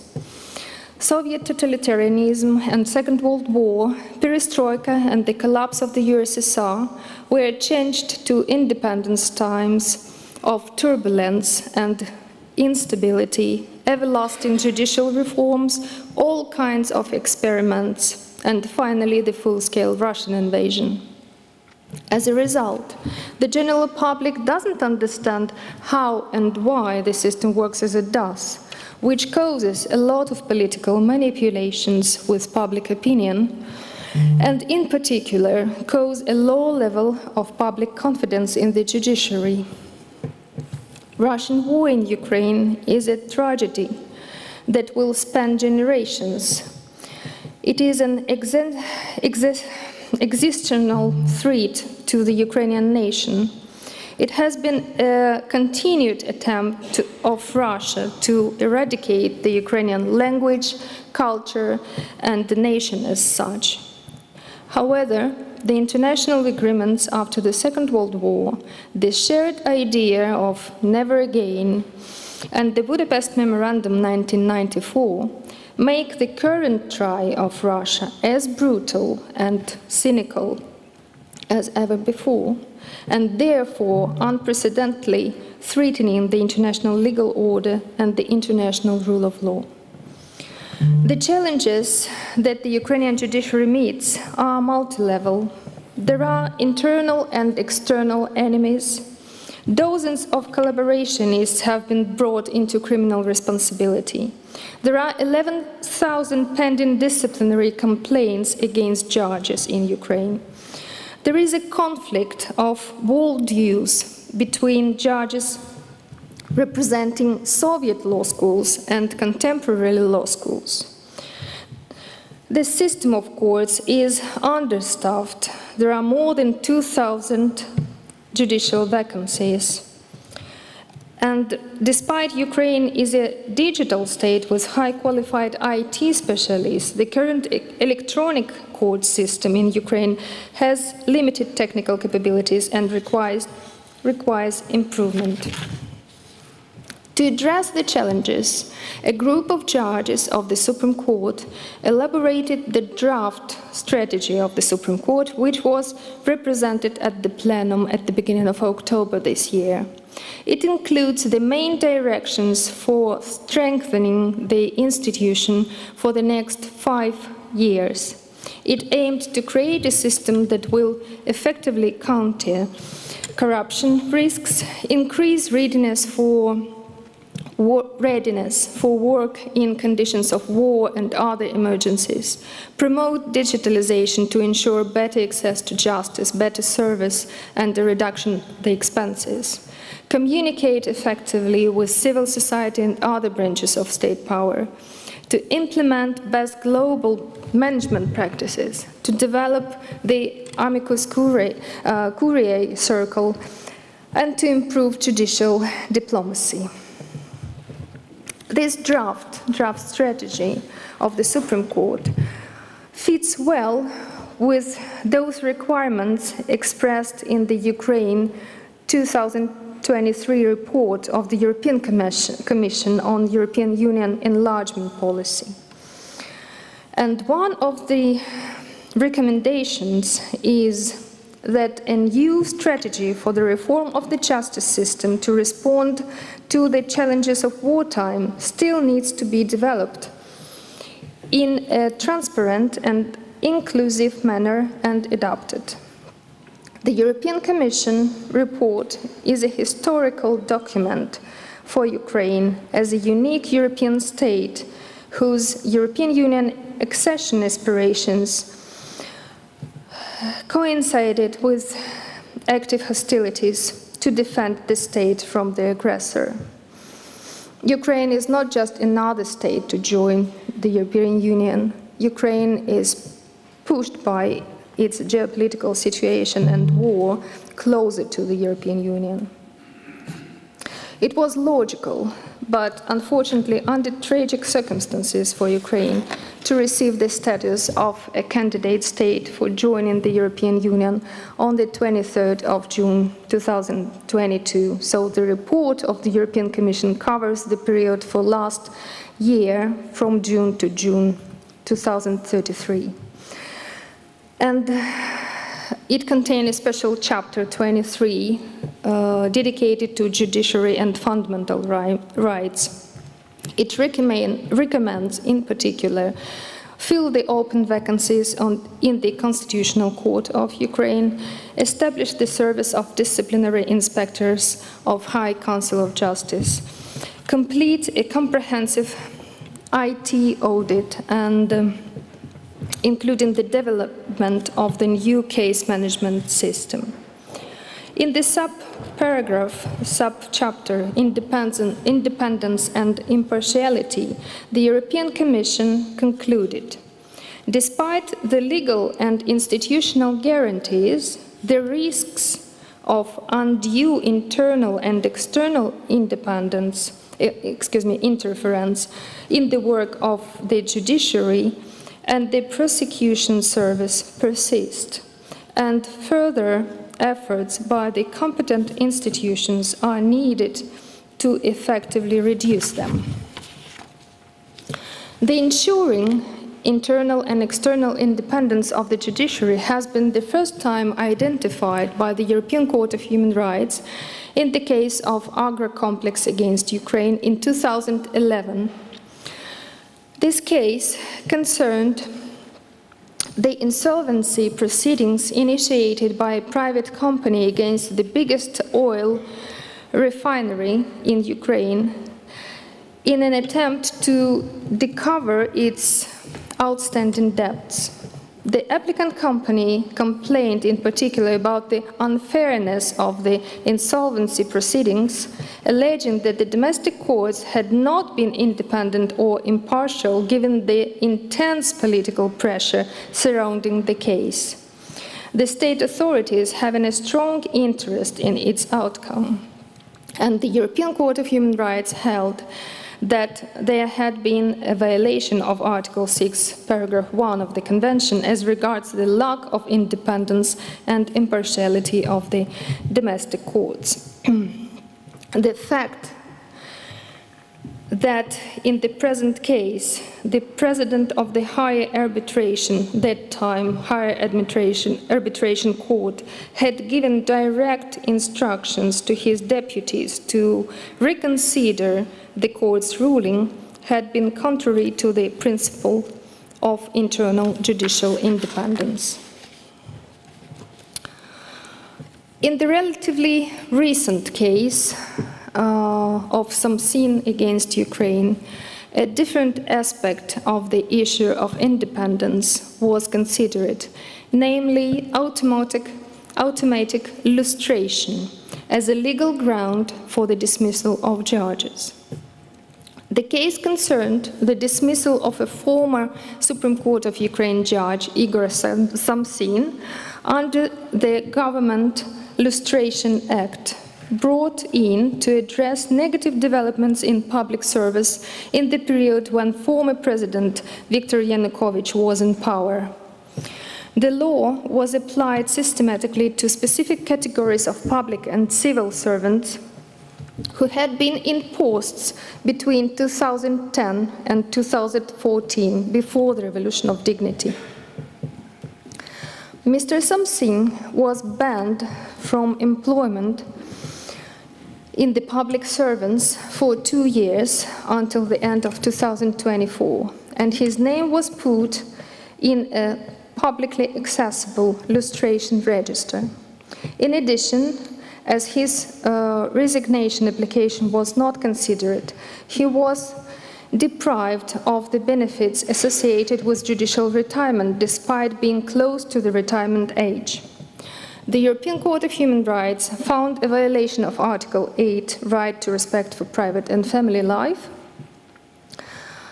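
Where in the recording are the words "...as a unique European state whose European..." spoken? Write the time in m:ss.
4:12.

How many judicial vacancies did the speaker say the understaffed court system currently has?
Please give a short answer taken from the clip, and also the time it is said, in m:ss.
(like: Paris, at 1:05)
more than 2,000, at 2:06.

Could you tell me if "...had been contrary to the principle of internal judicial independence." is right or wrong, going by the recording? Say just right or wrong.
right.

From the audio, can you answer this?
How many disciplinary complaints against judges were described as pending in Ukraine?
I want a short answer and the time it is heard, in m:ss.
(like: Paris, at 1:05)
11,000, at 1:45.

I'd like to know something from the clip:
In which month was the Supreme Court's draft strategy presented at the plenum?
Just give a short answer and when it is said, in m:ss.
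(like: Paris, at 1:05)
October, at 2:38.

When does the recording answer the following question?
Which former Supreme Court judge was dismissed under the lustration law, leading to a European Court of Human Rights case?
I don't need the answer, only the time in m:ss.
8:18.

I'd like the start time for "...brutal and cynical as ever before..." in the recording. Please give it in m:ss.
1:18.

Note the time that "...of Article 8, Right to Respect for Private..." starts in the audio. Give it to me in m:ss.
9:24.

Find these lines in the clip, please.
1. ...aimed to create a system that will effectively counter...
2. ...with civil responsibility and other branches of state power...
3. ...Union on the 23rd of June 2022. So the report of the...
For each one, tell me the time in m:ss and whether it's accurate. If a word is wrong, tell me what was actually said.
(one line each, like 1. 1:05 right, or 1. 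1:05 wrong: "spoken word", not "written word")
1. 2:48 right
2. 3:11 wrong: "society", not "responsibility"
3. 4:50 right.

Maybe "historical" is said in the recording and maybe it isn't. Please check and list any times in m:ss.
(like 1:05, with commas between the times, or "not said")
4:09.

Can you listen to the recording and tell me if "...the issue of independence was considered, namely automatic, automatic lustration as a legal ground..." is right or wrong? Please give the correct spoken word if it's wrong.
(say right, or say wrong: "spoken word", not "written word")
right.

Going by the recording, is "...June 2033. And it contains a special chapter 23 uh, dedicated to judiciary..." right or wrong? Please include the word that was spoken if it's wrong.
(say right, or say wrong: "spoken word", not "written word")
right.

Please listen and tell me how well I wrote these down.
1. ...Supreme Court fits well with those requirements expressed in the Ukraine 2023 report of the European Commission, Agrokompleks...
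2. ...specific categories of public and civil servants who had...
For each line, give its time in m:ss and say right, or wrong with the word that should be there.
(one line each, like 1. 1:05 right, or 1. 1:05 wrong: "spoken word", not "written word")
1. 3:31 wrong: "Commission", not "Agrokompleks"
2. 8:36 right.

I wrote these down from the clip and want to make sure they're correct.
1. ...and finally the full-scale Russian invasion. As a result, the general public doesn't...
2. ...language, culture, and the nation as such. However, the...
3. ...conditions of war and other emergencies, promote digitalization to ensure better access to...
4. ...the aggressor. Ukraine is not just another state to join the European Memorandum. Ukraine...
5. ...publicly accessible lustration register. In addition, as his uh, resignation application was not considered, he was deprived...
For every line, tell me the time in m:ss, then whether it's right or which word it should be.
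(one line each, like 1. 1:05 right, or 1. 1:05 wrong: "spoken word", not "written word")
1. 0:18 right
2. 1:00 right
3. 2:59 right
4. 4:25 wrong: "Union", not "Memorandum"
5. 9:03 right.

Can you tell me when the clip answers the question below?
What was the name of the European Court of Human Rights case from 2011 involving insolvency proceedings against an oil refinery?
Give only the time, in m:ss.
6:25.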